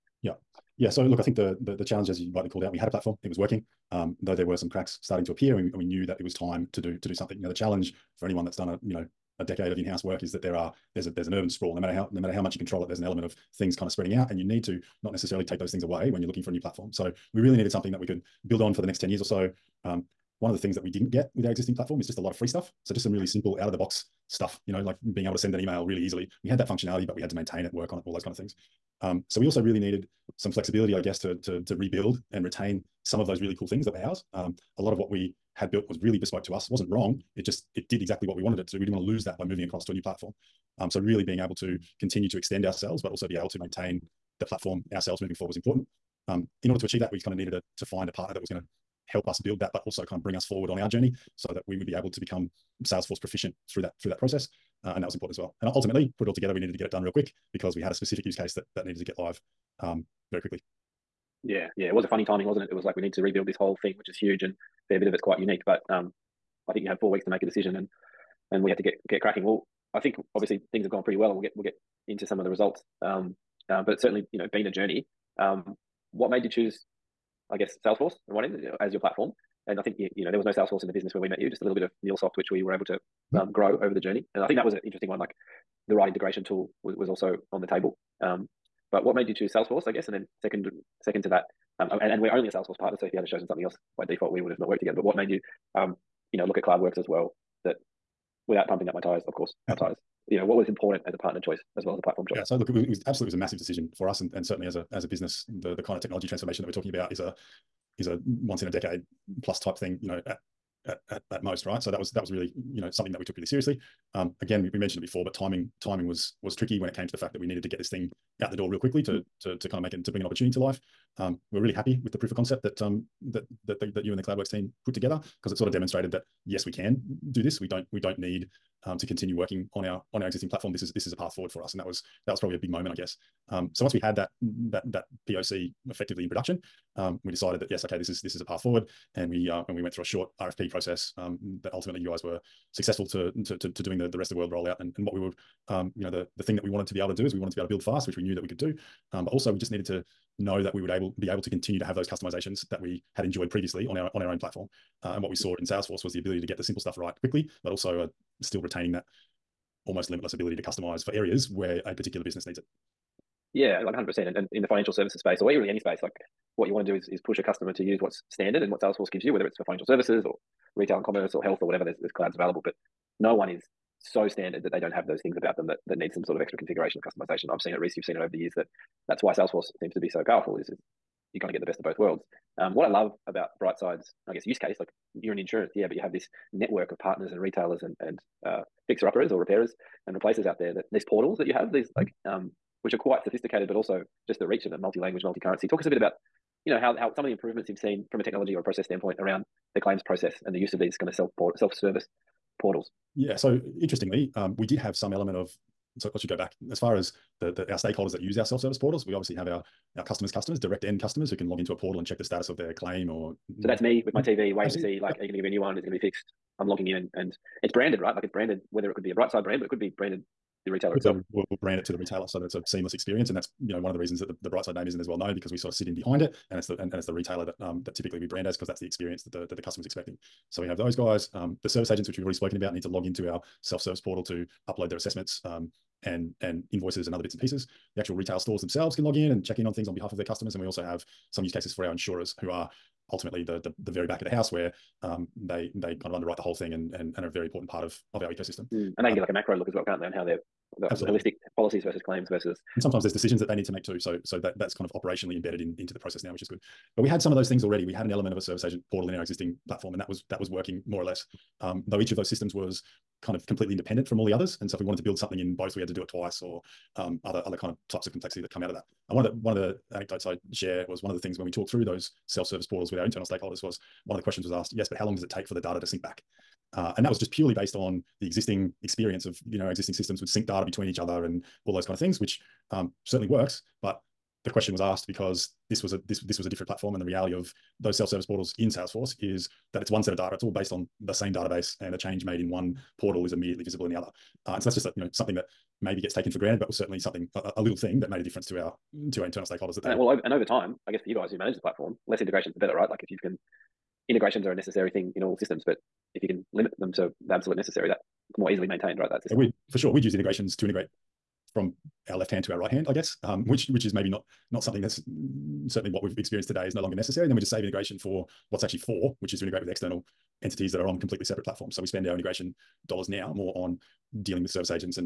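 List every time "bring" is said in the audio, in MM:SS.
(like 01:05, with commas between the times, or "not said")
00:50, 02:00.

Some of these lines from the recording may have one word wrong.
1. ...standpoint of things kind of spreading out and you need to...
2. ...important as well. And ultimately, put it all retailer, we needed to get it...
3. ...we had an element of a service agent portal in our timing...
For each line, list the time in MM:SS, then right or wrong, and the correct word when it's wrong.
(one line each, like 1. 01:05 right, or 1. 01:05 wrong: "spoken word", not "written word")
1. 00:13 wrong: "element", not "standpoint"
2. 00:55 wrong: "together", not "retailer"
3. 04:17 wrong: "existing", not "timing".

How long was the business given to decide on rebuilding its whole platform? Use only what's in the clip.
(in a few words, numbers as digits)
4 weeks.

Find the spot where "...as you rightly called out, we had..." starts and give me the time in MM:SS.
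00:02.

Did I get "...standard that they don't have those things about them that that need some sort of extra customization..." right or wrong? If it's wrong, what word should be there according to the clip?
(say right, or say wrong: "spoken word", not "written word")
wrong: "configuration", not "customization".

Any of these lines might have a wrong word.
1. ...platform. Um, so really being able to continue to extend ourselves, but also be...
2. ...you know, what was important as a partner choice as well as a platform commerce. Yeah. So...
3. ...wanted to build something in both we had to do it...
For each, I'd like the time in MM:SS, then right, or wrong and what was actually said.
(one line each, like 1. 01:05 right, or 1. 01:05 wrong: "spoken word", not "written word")
1. 00:40 right
2. 01:40 wrong: "choice", not "commerce"
3. 04:24 right.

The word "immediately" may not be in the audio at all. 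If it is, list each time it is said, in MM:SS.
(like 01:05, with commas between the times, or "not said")
04:53.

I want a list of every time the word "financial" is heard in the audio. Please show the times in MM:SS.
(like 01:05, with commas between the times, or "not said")
02:44, 02:49.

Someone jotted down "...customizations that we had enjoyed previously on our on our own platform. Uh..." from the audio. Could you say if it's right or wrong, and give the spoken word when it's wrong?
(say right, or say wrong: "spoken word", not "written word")
right.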